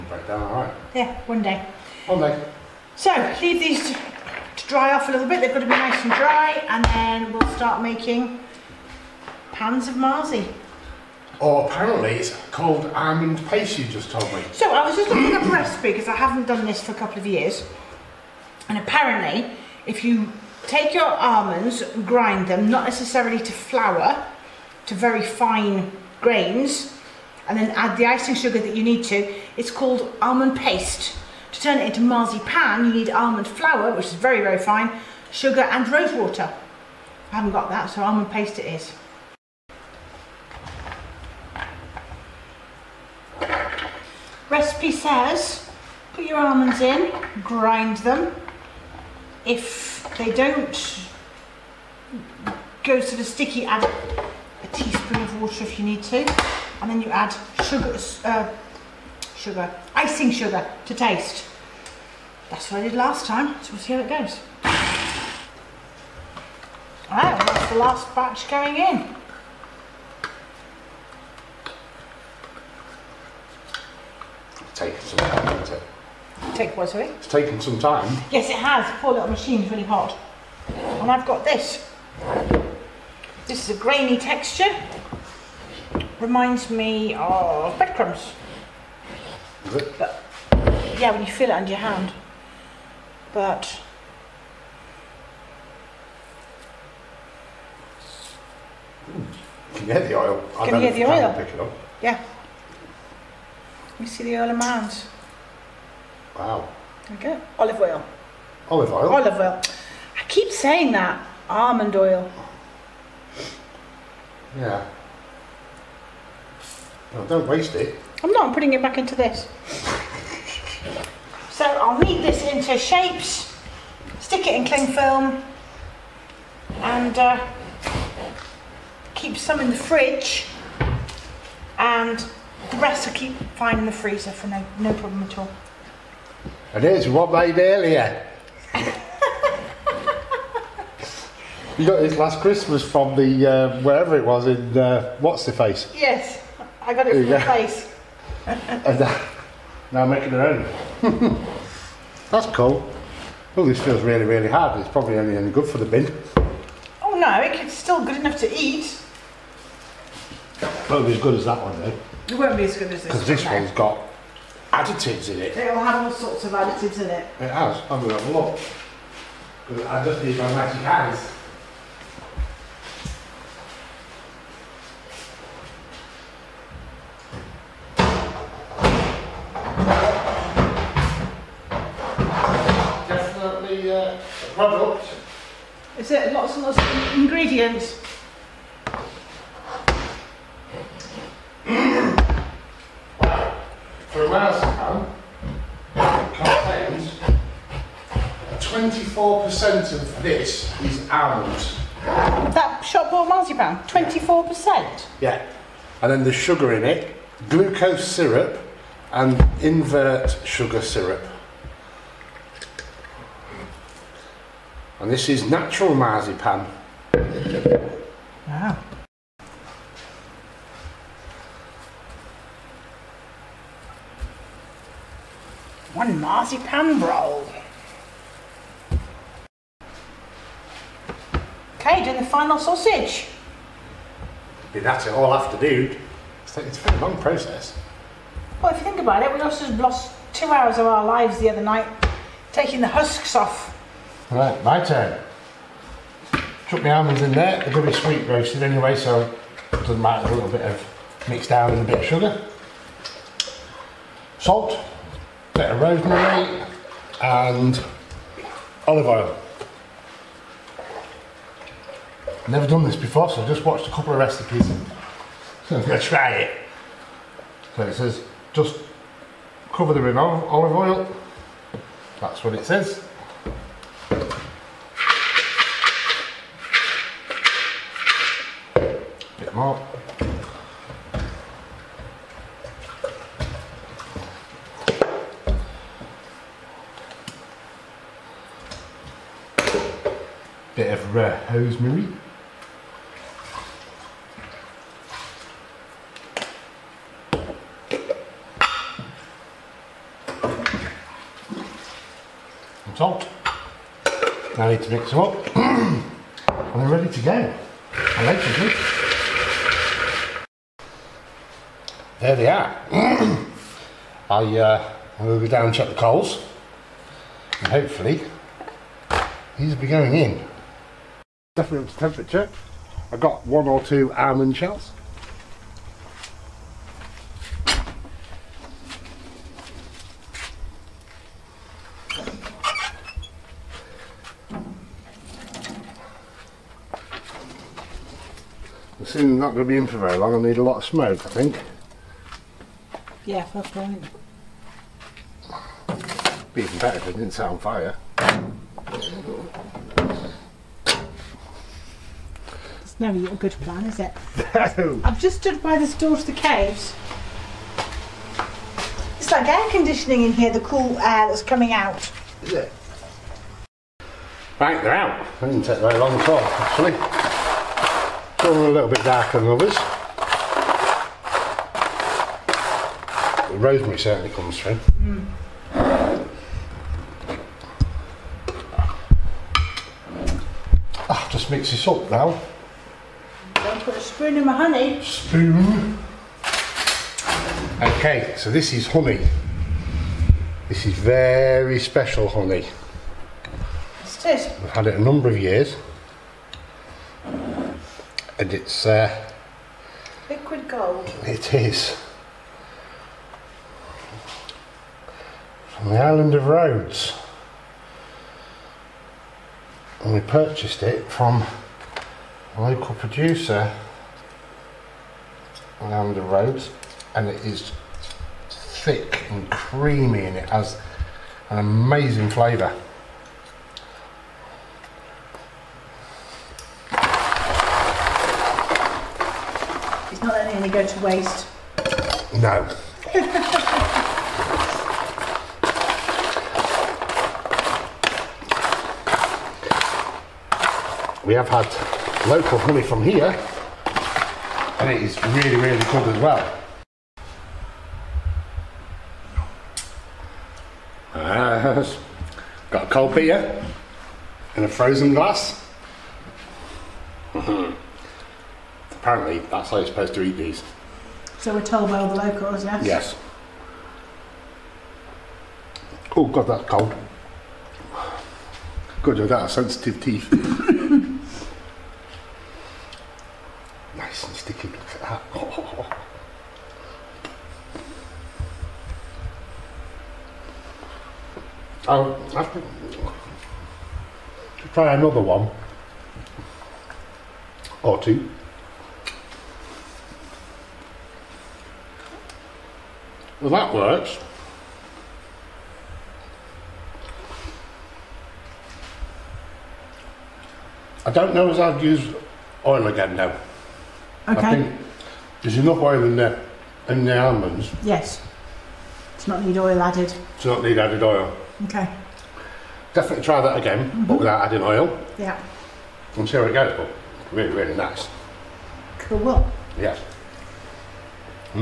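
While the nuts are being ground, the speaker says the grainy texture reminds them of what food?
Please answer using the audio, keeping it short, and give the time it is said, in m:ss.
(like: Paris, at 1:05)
Breadcrumbs, at 1:27.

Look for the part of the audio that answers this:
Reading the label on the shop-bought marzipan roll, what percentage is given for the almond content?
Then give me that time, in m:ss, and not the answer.
3:23.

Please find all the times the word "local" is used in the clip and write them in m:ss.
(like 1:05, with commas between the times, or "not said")
6:52, 7:22, 7:42.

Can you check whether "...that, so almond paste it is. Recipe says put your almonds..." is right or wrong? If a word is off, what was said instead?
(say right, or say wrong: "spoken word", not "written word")
right.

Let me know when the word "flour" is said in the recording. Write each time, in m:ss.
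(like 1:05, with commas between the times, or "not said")
0:23, 0:33.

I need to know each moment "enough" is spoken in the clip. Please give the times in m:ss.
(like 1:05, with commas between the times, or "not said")
2:38, 8:25.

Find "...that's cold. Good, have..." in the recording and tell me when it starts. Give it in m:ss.
7:46.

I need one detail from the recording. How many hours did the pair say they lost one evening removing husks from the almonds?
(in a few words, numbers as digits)
2 hours.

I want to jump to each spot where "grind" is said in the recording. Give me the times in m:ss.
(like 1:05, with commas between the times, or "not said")
0:22, 0:47.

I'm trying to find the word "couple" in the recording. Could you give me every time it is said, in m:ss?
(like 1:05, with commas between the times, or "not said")
0:16, 4:23.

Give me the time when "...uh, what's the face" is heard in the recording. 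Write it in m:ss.
2:24.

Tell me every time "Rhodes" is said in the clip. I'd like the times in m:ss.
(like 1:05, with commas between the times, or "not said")
6:46, 6:56.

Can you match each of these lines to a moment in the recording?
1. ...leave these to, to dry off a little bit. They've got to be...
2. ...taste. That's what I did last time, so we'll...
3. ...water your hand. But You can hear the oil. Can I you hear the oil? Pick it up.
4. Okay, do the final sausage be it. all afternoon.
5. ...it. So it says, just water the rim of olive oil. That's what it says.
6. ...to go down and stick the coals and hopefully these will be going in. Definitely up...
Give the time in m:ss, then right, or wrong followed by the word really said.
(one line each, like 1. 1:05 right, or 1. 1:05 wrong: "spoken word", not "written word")
1. 0:03 right
2. 1:00 right
3. 1:31 wrong: "under", not "water"
4. 3:51 right
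5. 4:26 wrong: "cover", not "water"
6. 5:15 wrong: "check", not "stick".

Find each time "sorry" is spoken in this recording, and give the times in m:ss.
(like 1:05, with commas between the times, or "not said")
1:16.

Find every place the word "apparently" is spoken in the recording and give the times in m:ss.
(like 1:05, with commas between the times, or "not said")
0:11, 0:18, 7:39.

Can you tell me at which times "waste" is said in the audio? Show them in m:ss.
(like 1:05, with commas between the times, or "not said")
1:57, 7:10.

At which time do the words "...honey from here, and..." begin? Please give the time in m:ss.
7:22.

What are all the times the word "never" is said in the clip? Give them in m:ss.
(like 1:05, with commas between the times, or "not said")
4:22, 5:52.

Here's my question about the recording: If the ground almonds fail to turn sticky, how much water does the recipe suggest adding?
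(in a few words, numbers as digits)
1 teaspoon.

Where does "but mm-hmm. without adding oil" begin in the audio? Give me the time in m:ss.
8:33.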